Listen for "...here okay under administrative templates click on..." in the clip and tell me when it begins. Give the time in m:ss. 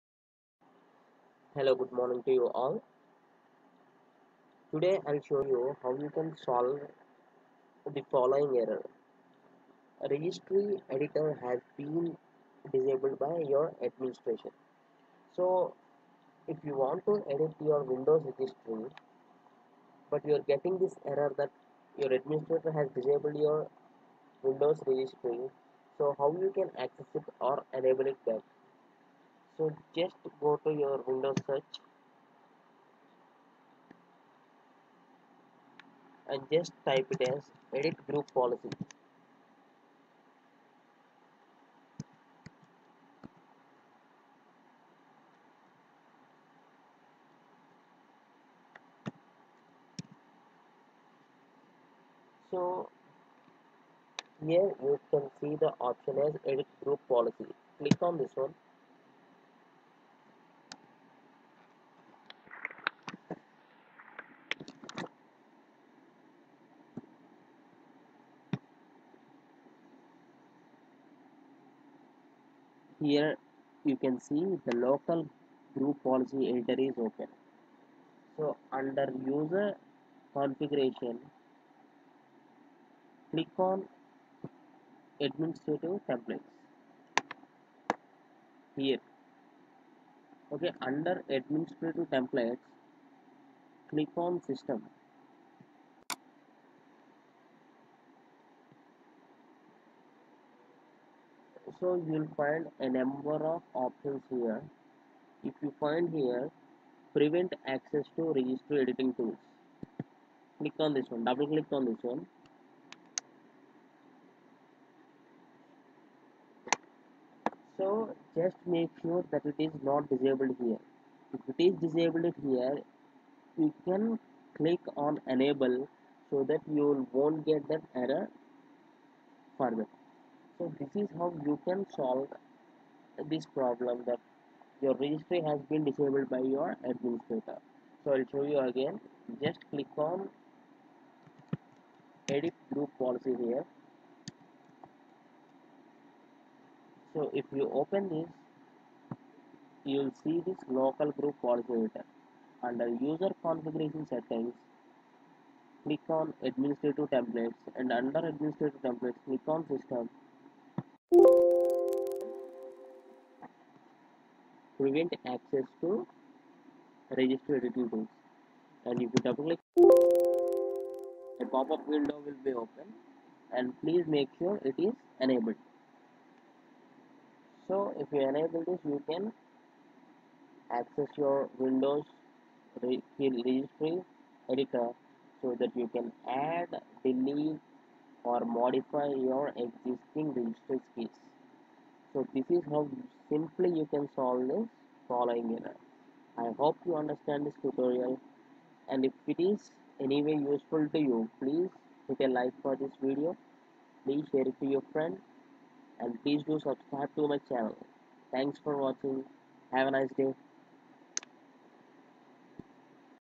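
1:28.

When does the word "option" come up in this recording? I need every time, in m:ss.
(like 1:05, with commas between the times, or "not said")
0:55, 1:43.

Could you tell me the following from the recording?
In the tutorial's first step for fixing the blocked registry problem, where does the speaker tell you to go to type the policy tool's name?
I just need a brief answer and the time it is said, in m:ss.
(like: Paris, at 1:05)
Windows search, at 0:31.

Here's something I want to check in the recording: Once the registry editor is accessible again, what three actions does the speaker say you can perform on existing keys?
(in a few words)
add, delete or modify.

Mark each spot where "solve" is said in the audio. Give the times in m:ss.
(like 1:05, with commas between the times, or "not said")
0:06, 2:11, 3:14.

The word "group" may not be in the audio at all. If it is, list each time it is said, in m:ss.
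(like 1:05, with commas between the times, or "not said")
0:38, 0:56, 1:15, 2:22, 2:31.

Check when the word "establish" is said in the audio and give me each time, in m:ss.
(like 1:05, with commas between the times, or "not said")
not said.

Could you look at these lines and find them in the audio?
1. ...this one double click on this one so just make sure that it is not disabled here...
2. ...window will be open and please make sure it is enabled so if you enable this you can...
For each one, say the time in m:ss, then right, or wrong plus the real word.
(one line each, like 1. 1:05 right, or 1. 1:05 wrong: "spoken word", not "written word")
1. 1:50 right
2. 2:51 right.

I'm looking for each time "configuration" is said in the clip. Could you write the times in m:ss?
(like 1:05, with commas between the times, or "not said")
1:20, 2:33.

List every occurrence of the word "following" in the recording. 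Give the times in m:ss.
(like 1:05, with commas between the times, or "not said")
0:08, 3:15.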